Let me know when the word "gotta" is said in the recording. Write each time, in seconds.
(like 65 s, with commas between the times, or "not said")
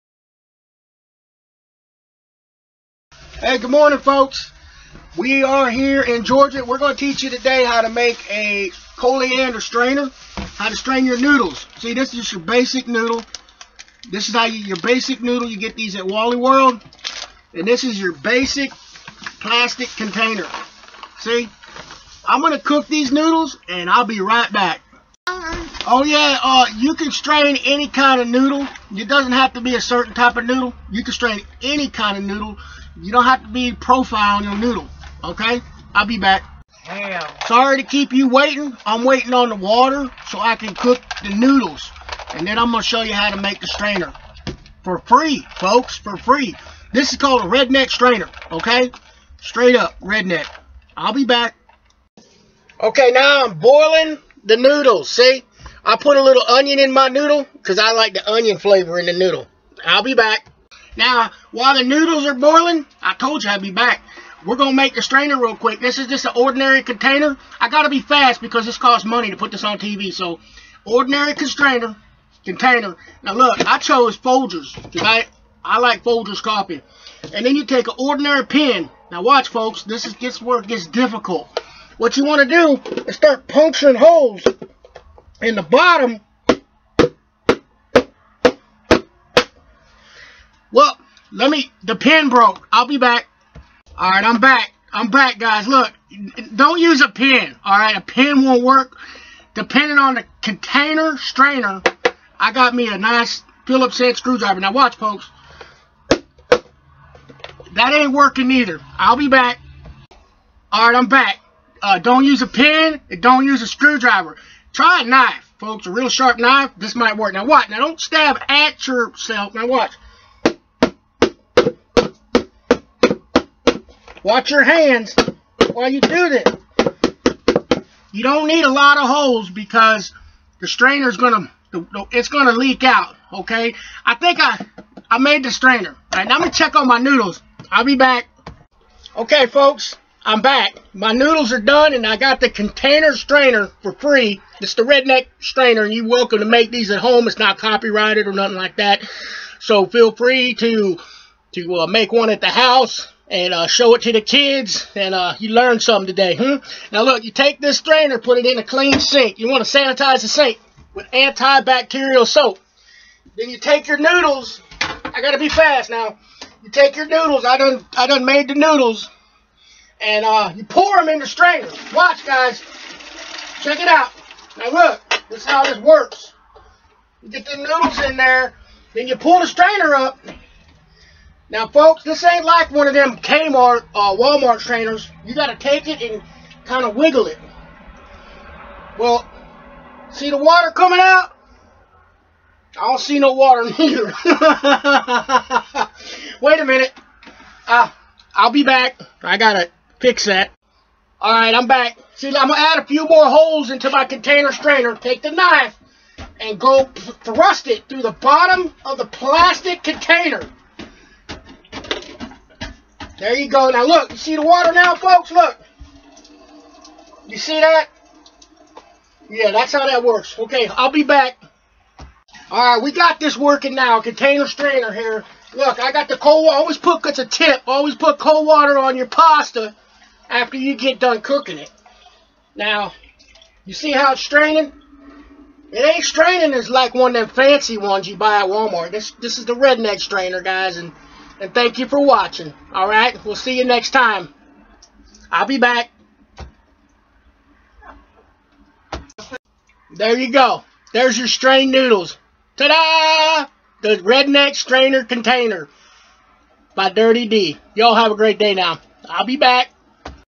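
165 s.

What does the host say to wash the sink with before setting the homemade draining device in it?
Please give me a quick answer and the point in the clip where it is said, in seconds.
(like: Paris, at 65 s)
Antibacterial soap, at 161 s.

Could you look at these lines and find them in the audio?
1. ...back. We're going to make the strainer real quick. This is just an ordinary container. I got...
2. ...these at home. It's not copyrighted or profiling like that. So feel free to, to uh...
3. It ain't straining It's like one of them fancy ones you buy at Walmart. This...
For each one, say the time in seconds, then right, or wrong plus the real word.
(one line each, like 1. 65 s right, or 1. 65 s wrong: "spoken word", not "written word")
1. 63 s right
2. 146 s wrong: "nothing", not "profiling"
3. 235 s right.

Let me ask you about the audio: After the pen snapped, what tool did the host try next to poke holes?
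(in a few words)
Phillips head screwdriver.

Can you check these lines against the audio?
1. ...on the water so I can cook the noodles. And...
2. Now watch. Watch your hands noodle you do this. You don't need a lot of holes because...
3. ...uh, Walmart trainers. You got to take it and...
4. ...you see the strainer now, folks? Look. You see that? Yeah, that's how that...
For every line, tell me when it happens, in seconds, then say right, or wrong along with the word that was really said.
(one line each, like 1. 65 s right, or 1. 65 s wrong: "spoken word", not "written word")
1. 39 s right
2. 119 s wrong: "while", not "noodle"
3. 183 s right
4. 214 s wrong: "water", not "strainer".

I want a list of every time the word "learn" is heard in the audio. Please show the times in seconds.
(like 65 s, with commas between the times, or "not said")
155 s.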